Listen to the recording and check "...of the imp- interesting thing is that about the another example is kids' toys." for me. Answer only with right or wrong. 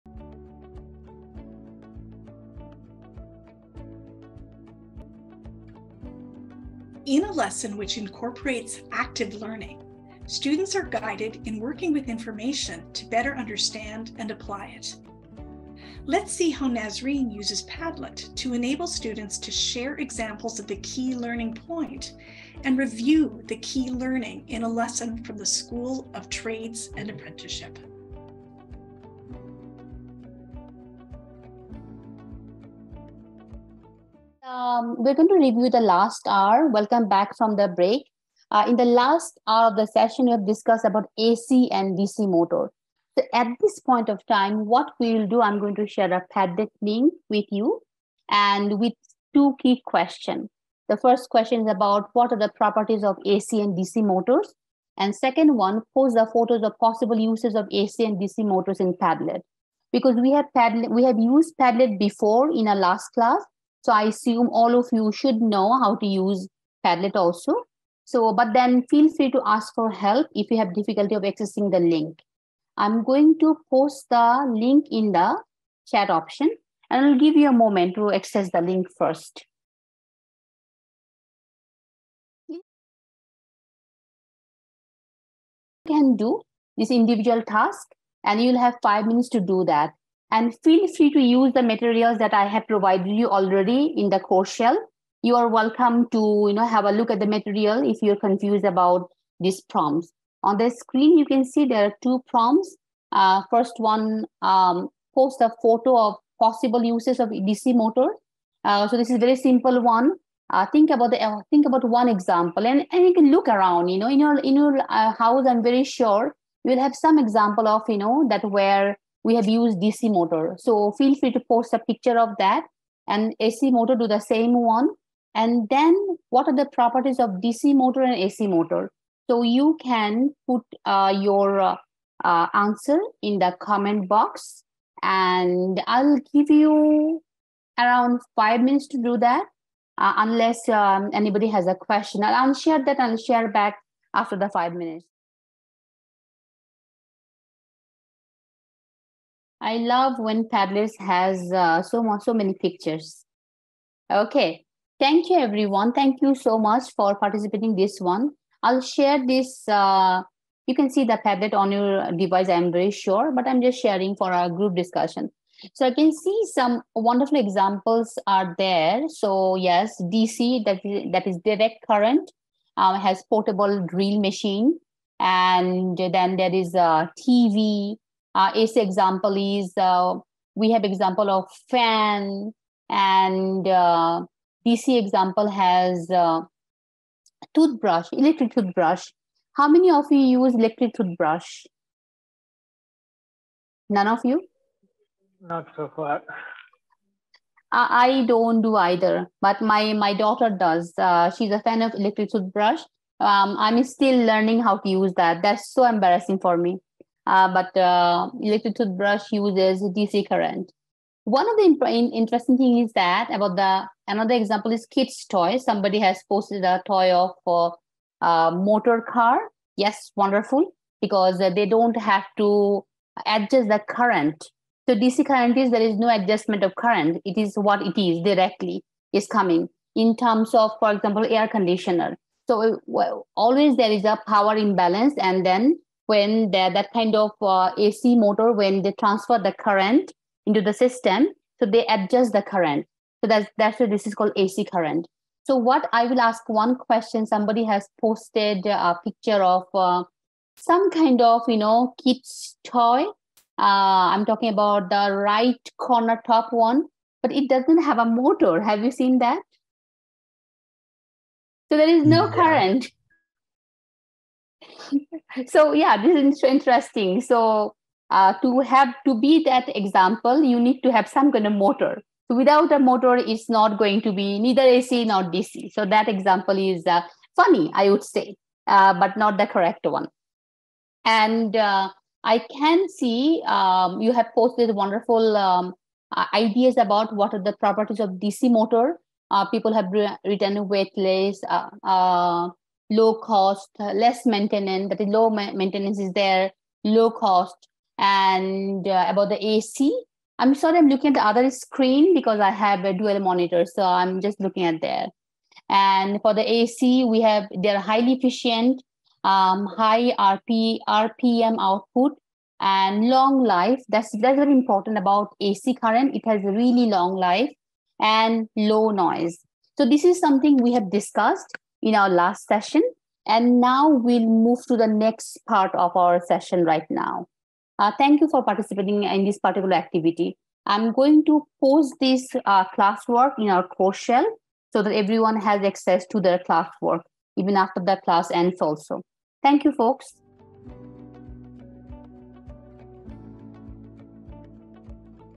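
right.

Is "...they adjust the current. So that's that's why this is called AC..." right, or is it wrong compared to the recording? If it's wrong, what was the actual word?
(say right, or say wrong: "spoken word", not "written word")
right.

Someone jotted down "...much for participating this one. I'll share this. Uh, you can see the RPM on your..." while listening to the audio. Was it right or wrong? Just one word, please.
wrong.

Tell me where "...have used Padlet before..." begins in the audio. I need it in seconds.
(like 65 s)
61 s.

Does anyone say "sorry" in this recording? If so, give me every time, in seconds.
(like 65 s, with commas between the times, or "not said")
300 s.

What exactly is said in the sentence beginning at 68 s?
So, but then feel free to ask for help if you have difficulty of accessing the link.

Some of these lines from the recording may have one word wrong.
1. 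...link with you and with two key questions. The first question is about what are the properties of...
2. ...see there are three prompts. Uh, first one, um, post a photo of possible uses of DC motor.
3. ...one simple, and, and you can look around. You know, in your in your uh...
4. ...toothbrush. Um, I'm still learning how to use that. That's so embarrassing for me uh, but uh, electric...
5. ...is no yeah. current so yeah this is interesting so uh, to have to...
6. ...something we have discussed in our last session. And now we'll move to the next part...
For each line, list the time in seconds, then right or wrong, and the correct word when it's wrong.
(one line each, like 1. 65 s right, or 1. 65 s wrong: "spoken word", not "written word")
1. 46 s right
2. 101 s wrong: "two", not "three"
3. 111 s wrong: "example", not "simple"
4. 202 s right
5. 261 s right
6. 320 s right.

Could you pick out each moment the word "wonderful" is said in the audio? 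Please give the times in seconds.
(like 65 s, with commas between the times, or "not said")
166 s, 220 s, 284 s.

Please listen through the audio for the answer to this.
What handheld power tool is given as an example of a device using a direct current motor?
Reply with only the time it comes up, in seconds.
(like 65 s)
173 s.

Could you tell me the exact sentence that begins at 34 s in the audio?
um, we're going to review the last hour.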